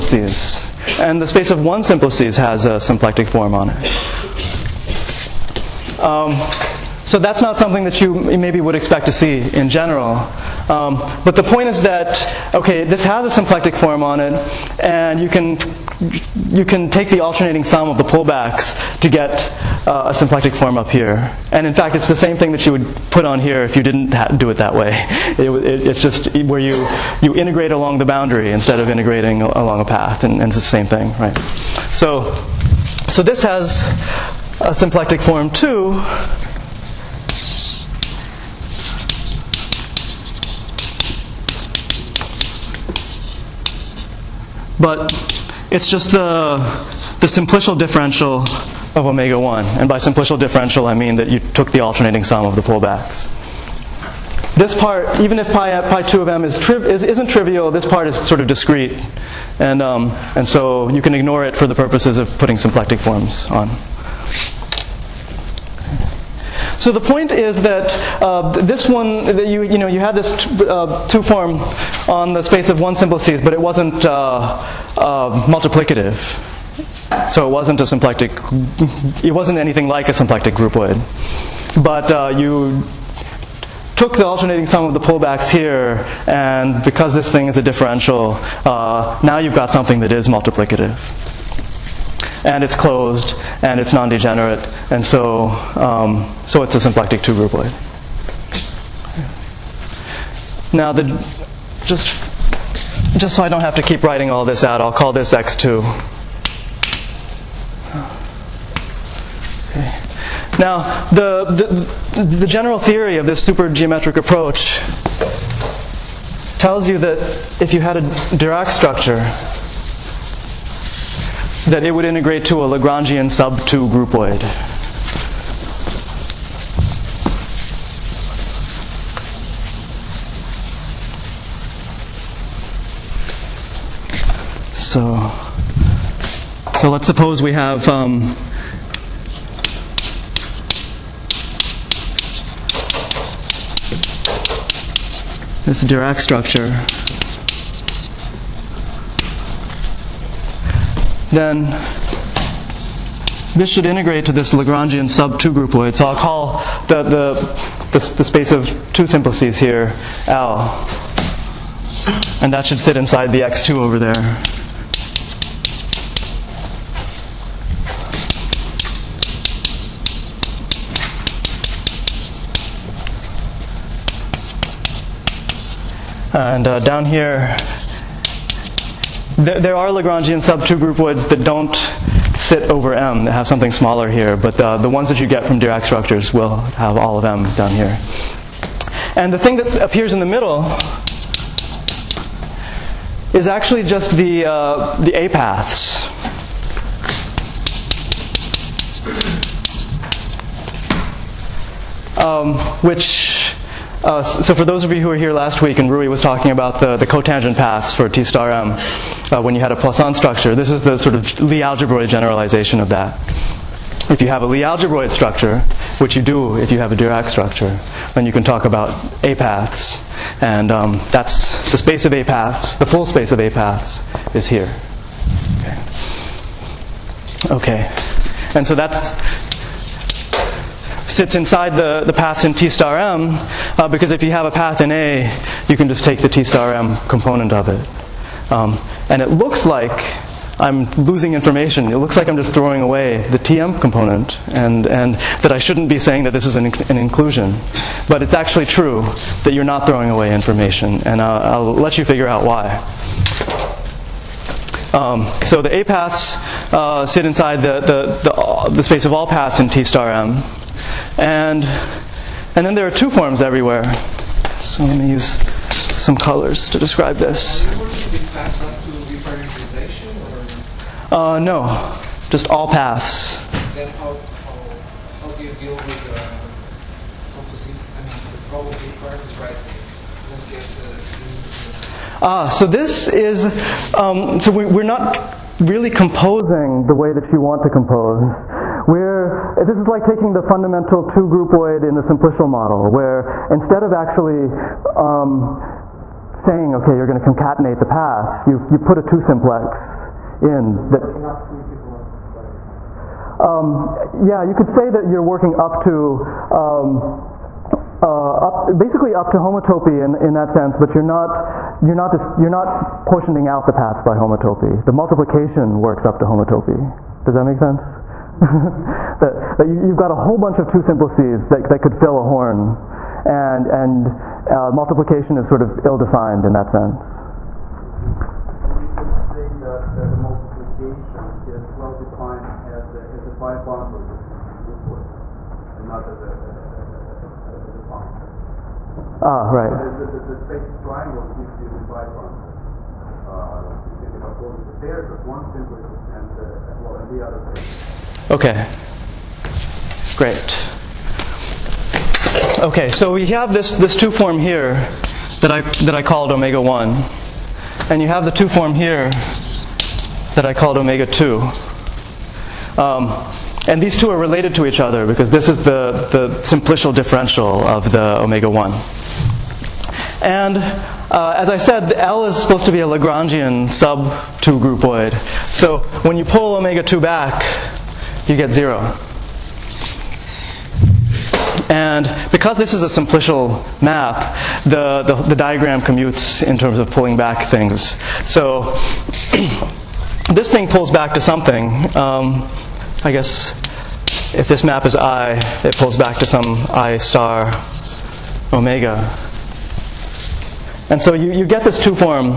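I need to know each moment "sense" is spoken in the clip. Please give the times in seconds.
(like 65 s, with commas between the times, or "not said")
310 s, 317 s, 326 s.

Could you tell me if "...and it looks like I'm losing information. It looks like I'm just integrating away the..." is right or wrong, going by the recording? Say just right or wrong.
wrong.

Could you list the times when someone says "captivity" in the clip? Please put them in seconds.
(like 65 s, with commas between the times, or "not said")
not said.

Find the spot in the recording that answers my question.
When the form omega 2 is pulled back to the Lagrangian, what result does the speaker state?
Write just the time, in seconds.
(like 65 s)
378 s.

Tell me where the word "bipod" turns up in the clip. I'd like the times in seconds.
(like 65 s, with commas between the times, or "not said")
341 s.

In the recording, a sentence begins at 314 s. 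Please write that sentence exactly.
The multiplication works up to homotopy.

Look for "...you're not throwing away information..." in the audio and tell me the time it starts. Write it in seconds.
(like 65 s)
249 s.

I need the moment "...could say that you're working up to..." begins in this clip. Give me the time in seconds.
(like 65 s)
304 s.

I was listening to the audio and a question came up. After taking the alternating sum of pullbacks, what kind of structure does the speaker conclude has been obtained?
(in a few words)
Symplectic two groupoid.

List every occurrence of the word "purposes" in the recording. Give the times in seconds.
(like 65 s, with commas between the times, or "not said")
61 s.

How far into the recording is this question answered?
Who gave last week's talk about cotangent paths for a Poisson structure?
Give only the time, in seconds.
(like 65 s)
205 s.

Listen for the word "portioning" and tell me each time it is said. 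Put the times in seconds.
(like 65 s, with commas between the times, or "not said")
313 s.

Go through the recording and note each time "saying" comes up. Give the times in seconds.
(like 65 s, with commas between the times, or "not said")
245 s, 296 s.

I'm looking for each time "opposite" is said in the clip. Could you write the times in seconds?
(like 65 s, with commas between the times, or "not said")
344 s.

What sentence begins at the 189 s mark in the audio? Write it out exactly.
And the thing that appears in the middle is actually just the, uh, the A paths.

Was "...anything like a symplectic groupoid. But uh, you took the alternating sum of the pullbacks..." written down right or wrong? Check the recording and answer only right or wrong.
right.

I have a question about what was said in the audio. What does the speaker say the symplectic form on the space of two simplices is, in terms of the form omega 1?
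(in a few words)
Simplicial differential of omega 1.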